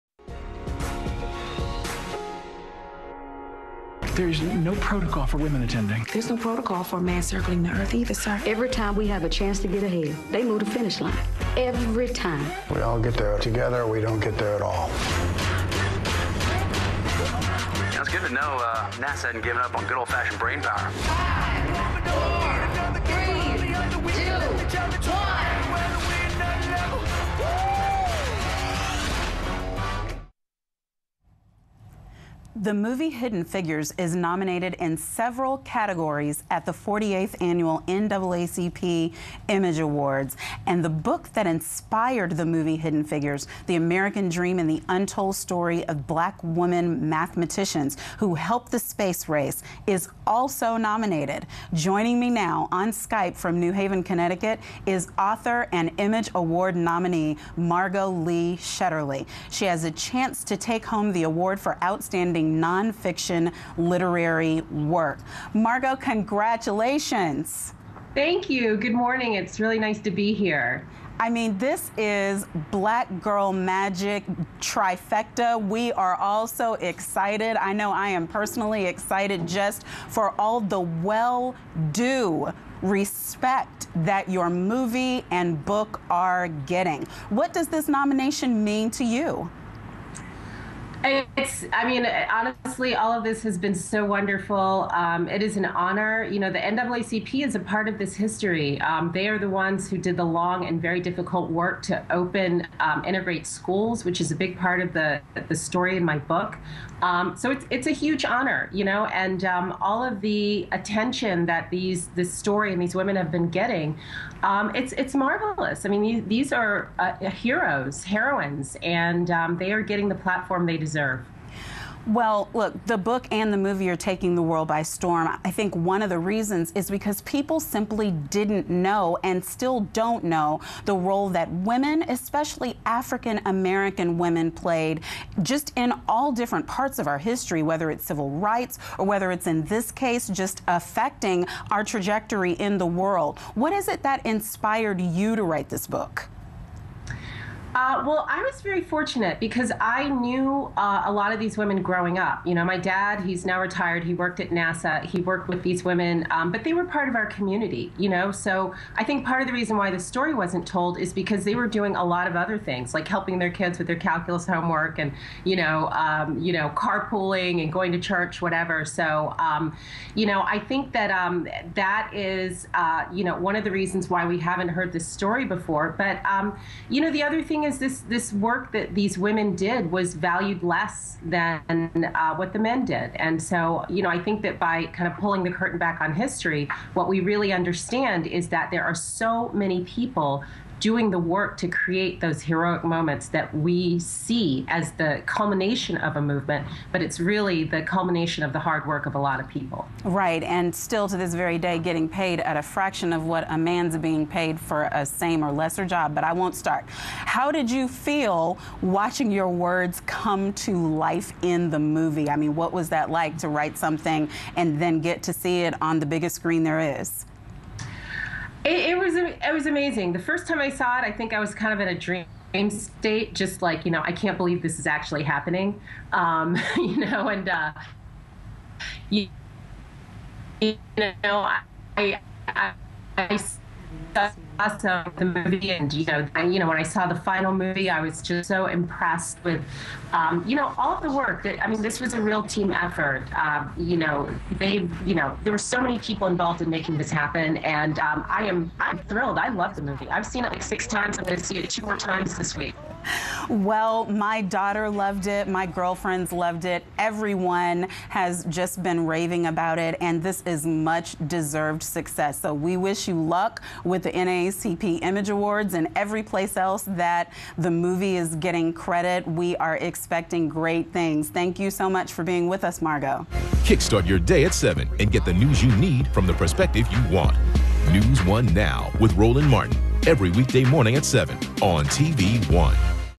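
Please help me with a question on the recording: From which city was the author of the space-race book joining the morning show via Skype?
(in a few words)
New Haven, Connecticut.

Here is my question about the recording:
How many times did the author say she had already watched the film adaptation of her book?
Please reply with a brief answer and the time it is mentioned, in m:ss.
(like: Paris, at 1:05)
6, at 4:10.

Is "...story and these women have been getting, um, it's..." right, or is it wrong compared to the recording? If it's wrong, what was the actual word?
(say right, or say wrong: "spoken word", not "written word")
right.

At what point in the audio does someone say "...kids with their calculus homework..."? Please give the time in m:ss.
2:43.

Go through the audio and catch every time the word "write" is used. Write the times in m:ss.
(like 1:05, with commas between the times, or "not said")
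2:25, 3:33.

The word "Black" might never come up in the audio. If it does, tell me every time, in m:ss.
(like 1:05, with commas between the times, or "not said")
0:46, 1:12.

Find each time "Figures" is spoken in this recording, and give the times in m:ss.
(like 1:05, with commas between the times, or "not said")
0:33, 0:43.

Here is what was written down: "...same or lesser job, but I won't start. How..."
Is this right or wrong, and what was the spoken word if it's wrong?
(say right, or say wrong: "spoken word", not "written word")
right.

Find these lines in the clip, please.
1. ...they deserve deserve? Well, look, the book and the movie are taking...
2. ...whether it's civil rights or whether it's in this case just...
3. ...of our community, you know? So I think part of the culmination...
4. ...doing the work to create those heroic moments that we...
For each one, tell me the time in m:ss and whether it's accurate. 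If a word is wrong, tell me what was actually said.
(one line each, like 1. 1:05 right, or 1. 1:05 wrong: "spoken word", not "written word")
1. 2:00 right
2. 2:17 right
3. 2:37 wrong: "reason", not "culmination"
4. 3:10 right.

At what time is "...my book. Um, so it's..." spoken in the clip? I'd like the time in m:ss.
1:46.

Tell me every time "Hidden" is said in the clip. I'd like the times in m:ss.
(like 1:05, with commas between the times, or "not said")
0:33, 0:42.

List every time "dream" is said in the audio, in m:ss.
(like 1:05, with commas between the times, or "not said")
0:44, 3:41.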